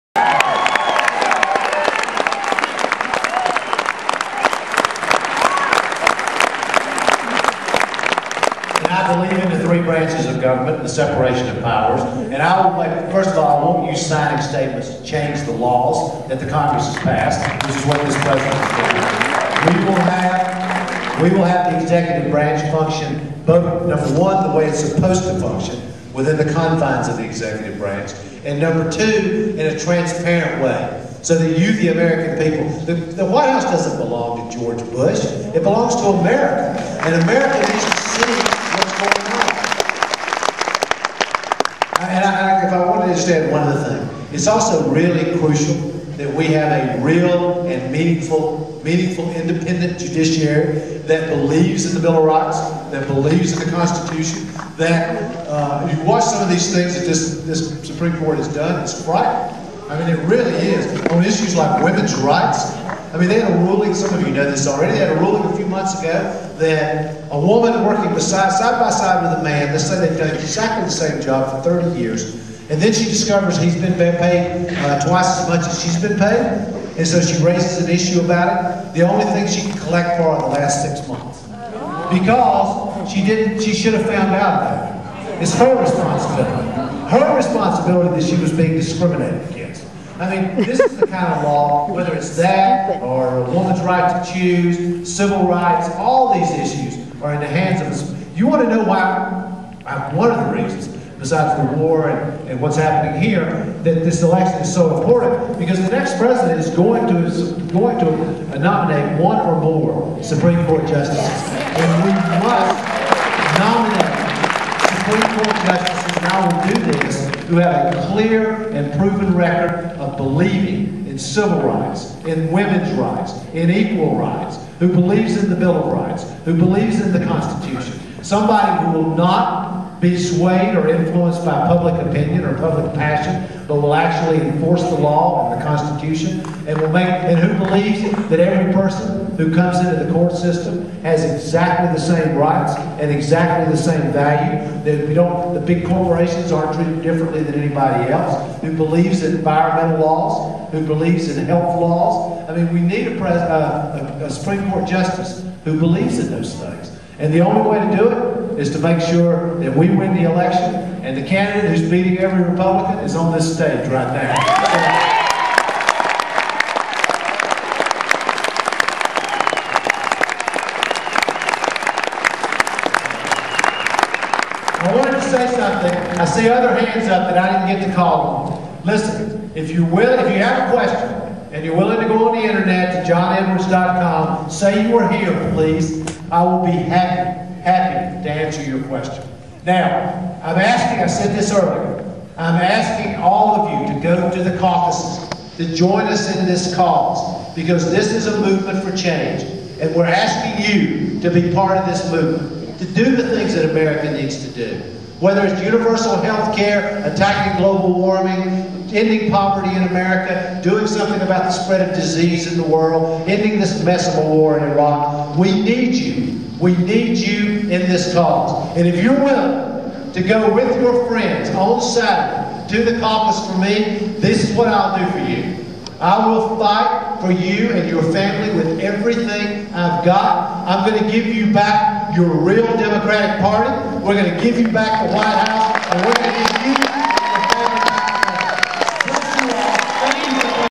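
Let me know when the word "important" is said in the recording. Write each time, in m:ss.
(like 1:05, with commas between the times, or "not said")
1:44.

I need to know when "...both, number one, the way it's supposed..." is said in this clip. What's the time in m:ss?
0:23.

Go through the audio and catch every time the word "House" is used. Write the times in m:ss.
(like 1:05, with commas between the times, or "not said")
0:33, 3:55.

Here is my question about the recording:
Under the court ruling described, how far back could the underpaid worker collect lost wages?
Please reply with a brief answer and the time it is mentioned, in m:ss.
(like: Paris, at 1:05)
last 6 months, at 1:20.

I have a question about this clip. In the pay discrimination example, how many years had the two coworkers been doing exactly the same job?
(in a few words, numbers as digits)
30.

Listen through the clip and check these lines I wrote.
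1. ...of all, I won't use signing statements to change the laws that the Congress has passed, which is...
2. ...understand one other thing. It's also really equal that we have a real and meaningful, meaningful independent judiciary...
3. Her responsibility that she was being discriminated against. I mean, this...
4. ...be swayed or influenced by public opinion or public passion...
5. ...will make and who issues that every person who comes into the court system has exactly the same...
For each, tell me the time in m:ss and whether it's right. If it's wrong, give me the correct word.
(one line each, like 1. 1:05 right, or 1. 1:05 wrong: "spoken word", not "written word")
1. 0:13 right
2. 0:43 wrong: "crucial", not "equal"
3. 1:27 right
4. 2:10 right
5. 2:16 wrong: "believes", not "issues".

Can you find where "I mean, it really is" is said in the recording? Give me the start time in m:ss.
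0:59.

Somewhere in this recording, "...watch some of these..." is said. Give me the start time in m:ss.
0:56.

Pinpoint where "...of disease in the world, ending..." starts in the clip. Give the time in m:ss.
3:31.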